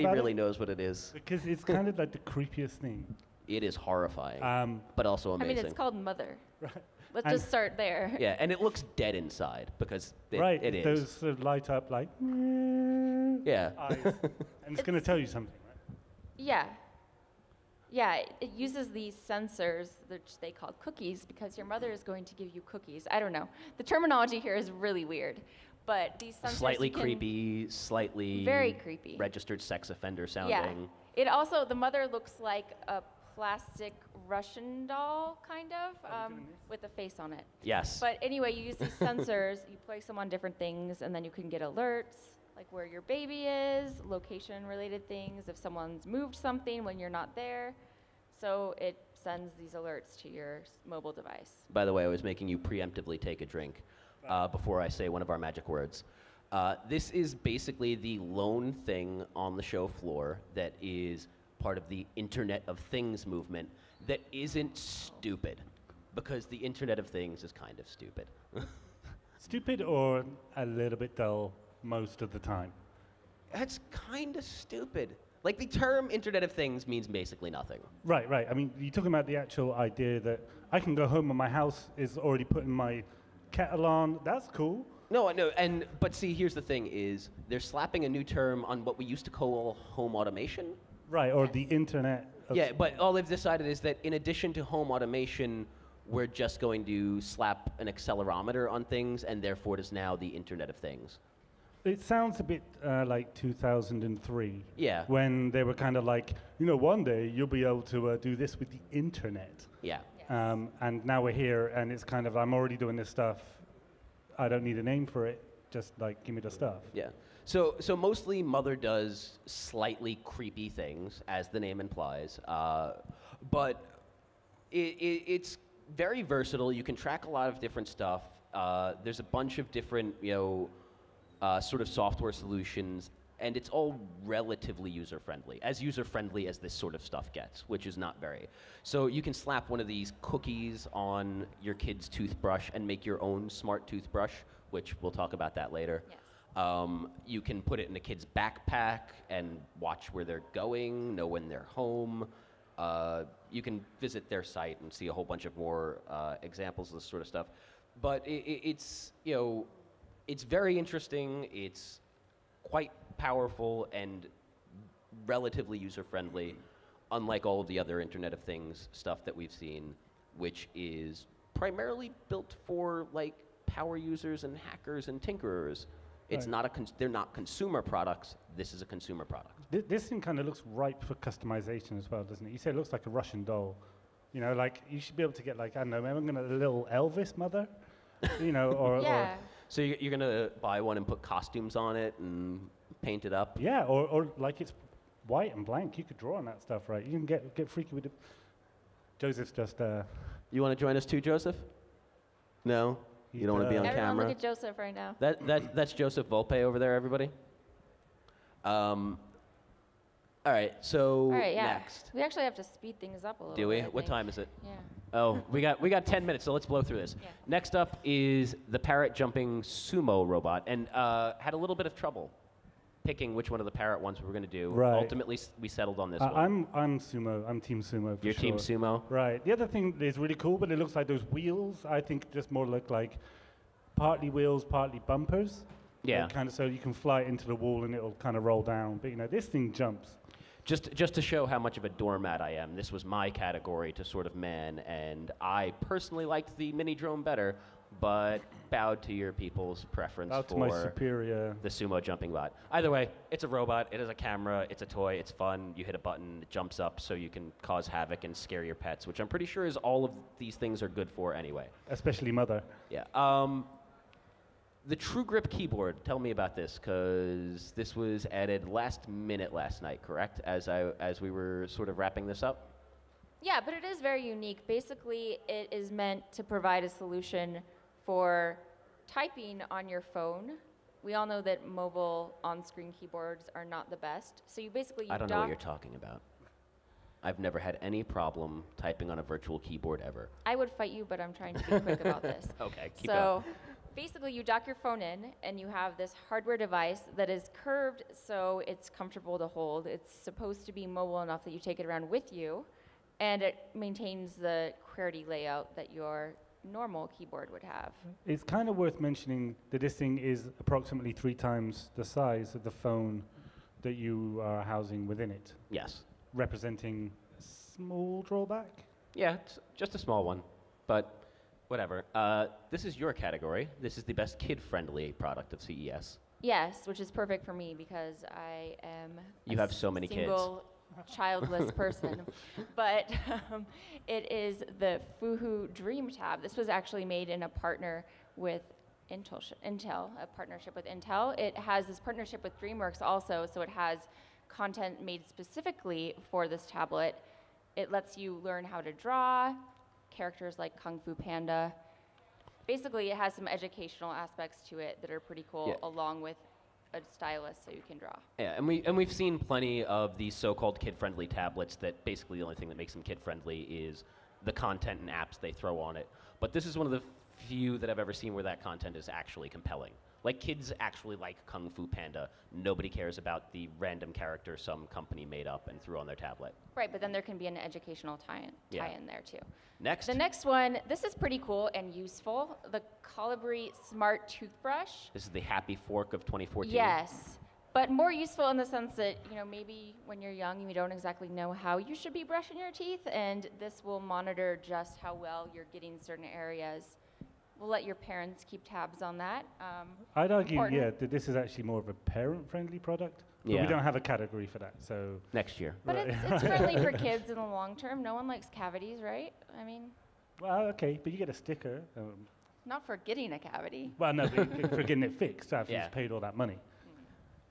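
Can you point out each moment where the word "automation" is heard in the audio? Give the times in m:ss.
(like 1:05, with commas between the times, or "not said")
1:30, 1:34.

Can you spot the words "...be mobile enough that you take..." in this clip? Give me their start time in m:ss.
5:00.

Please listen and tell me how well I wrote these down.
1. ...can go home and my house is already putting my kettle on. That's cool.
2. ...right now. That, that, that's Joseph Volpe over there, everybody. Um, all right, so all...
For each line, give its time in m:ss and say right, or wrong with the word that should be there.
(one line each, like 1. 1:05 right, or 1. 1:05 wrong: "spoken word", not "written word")
1. 1:20 right
2. 3:24 right.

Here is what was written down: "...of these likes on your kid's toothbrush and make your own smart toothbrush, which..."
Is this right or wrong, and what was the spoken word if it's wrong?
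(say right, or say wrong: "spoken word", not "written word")
wrong: "cookies", not "likes".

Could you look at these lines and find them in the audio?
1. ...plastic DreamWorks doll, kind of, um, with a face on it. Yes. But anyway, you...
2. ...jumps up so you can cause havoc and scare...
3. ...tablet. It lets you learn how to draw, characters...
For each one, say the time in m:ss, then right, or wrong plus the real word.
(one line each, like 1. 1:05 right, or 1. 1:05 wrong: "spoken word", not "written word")
1. 0:33 wrong: "Russian", not "DreamWorks"
2. 4:16 right
3. 5:46 right.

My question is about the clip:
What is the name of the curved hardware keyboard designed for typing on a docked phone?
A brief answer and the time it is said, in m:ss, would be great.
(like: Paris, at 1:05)
True Grip, at 4:24.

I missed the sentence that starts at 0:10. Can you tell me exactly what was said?
Those sort of light up like yeah.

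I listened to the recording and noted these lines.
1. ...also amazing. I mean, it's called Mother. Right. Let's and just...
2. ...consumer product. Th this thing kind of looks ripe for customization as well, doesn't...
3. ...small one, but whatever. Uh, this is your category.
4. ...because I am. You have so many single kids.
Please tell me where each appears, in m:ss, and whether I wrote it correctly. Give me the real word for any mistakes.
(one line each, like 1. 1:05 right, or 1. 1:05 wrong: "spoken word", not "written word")
1. 0:05 right
2. 2:58 right
3. 5:19 right
4. 5:27 right.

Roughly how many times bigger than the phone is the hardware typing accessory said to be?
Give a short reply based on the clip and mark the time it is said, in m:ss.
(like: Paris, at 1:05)
3, at 5:11.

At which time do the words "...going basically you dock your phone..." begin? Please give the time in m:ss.
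4:53.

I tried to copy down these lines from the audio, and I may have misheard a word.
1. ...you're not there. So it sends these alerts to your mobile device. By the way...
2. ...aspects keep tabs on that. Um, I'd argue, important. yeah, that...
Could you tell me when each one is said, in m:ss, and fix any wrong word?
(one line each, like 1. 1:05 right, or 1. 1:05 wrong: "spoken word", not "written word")
1. 0:46 right
2. 6:37 wrong: "parents", not "aspects".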